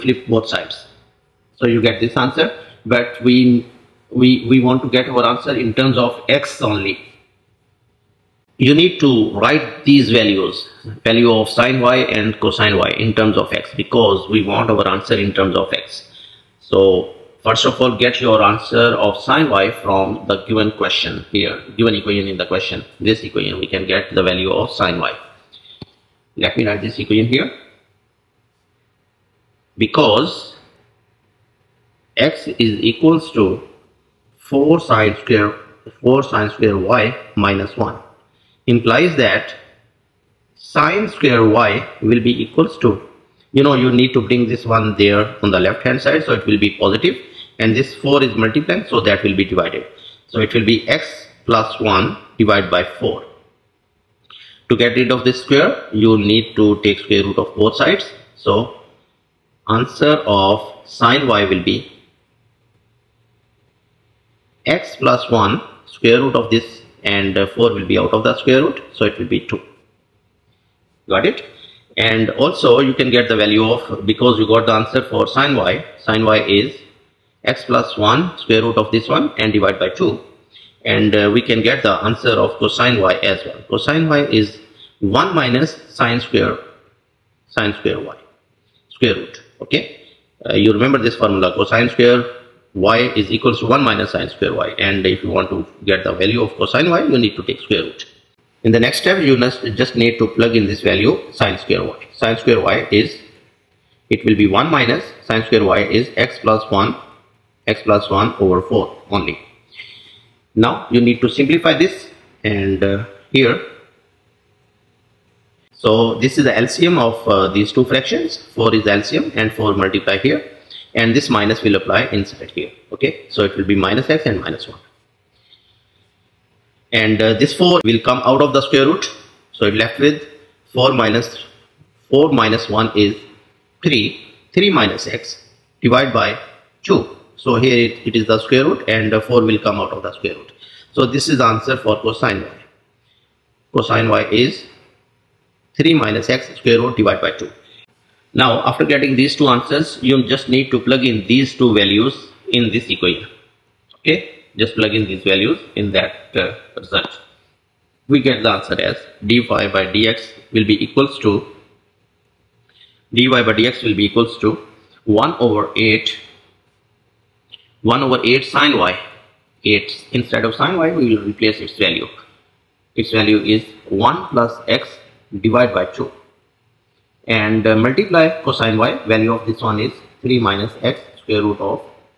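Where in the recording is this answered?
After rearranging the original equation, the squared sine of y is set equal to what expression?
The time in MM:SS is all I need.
00:50.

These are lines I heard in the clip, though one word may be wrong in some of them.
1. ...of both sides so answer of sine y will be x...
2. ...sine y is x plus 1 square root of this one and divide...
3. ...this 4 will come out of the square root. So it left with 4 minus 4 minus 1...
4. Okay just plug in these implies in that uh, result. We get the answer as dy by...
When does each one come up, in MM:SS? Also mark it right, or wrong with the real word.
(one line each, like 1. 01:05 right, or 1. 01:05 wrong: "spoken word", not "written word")
1. 00:57 right
2. 01:16 right
3. 02:07 right
4. 02:33 wrong: "values", not "implies".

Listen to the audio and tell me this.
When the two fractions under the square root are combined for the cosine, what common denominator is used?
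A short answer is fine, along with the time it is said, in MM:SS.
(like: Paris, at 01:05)
4, at 01:58.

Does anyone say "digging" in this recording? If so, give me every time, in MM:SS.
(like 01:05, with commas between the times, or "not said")
not said.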